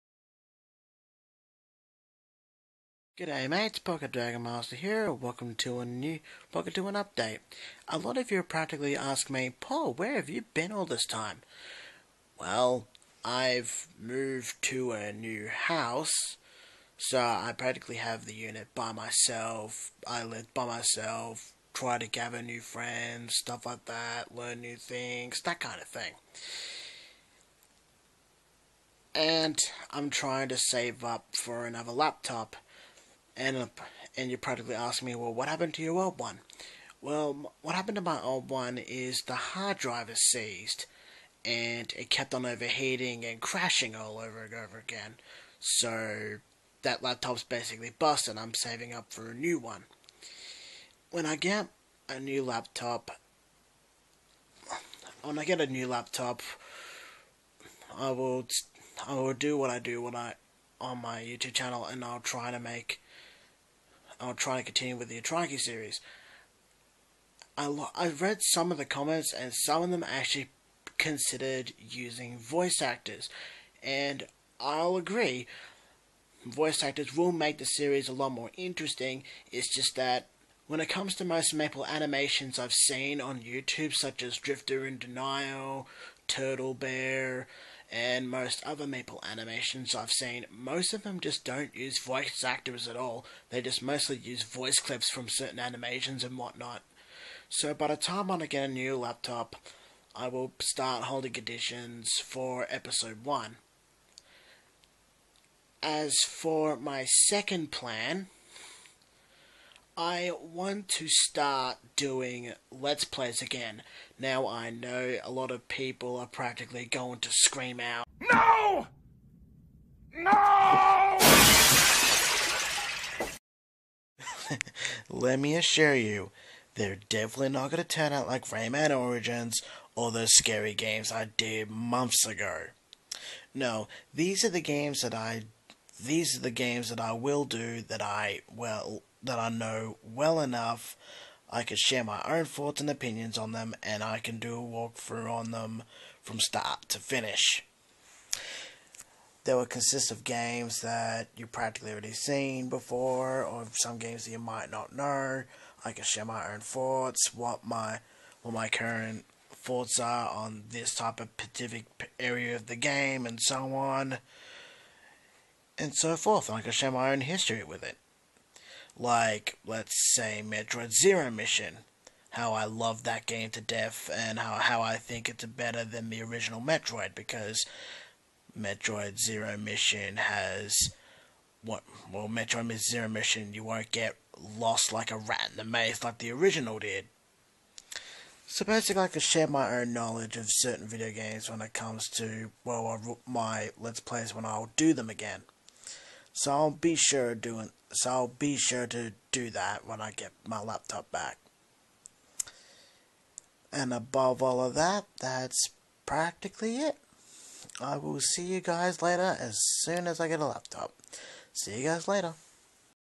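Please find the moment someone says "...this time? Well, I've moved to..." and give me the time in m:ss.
0:10.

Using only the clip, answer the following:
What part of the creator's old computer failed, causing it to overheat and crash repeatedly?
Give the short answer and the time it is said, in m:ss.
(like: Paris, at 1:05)
Hard drive, at 0:39.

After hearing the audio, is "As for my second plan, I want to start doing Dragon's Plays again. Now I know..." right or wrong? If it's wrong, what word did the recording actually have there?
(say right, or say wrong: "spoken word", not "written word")
wrong: "Let", not "Dragon".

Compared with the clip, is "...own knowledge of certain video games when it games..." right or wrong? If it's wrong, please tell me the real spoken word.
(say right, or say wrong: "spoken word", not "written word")
wrong: "comes", not "games".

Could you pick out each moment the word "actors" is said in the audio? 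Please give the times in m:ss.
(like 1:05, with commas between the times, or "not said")
1:12, 1:16, 1:32.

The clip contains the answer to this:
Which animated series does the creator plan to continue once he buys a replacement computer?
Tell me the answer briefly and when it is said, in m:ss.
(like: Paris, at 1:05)
Atraki, at 1:05.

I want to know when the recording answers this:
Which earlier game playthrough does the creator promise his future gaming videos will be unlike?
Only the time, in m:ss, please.
2:08.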